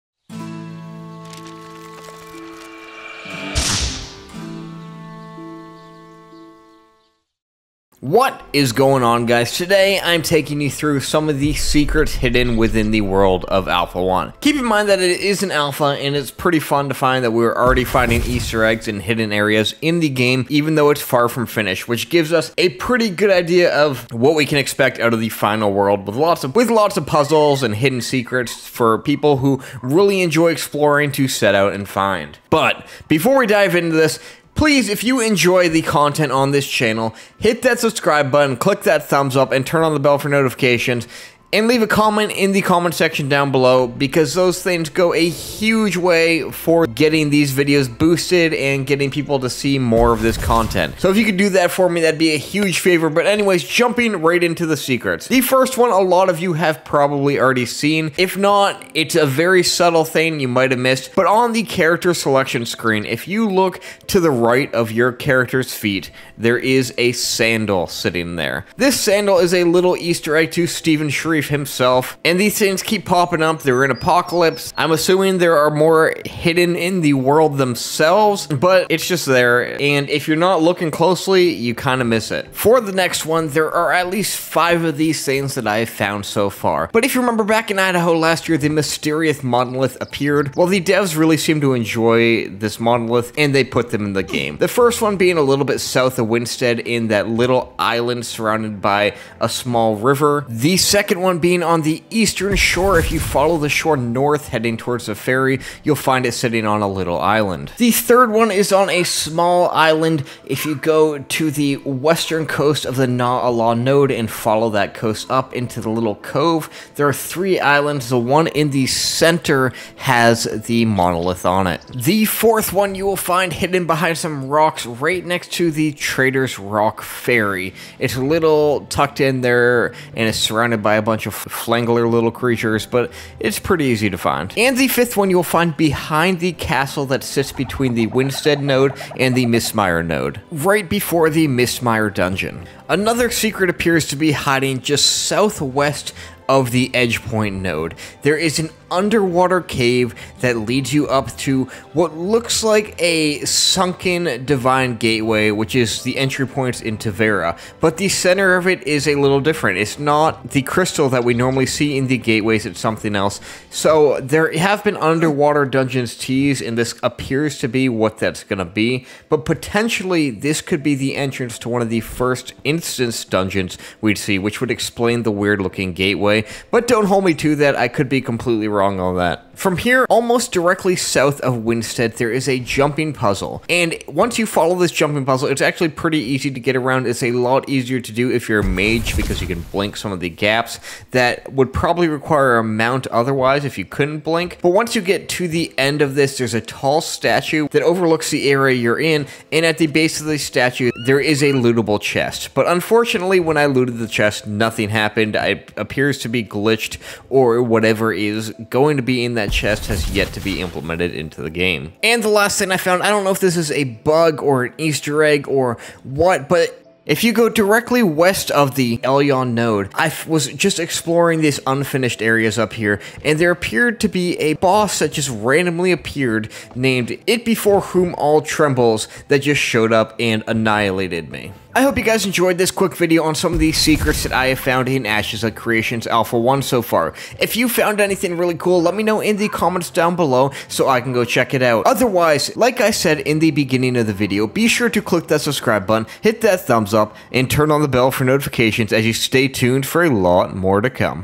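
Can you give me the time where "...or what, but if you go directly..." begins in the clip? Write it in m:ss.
3:35.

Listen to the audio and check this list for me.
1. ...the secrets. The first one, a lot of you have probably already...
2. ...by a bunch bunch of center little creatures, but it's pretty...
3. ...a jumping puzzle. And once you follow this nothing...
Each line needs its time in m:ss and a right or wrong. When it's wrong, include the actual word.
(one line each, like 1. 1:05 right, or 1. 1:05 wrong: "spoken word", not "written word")
1. 0:54 right
2. 2:10 wrong: "flangler", not "center"
3. 3:02 wrong: "jumping", not "nothing".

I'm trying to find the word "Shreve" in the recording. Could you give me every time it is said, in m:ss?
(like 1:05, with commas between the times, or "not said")
1:11.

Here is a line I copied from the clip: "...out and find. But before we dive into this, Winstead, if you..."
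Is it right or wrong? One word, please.
wrong.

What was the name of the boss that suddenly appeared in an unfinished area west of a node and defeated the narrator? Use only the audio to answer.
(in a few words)
It Before Whom All Trembles.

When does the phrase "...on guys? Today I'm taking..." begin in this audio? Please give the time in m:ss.
0:09.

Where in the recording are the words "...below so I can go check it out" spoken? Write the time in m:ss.
4:00.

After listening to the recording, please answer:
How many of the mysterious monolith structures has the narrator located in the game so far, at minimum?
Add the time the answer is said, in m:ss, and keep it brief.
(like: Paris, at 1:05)
5, at 1:24.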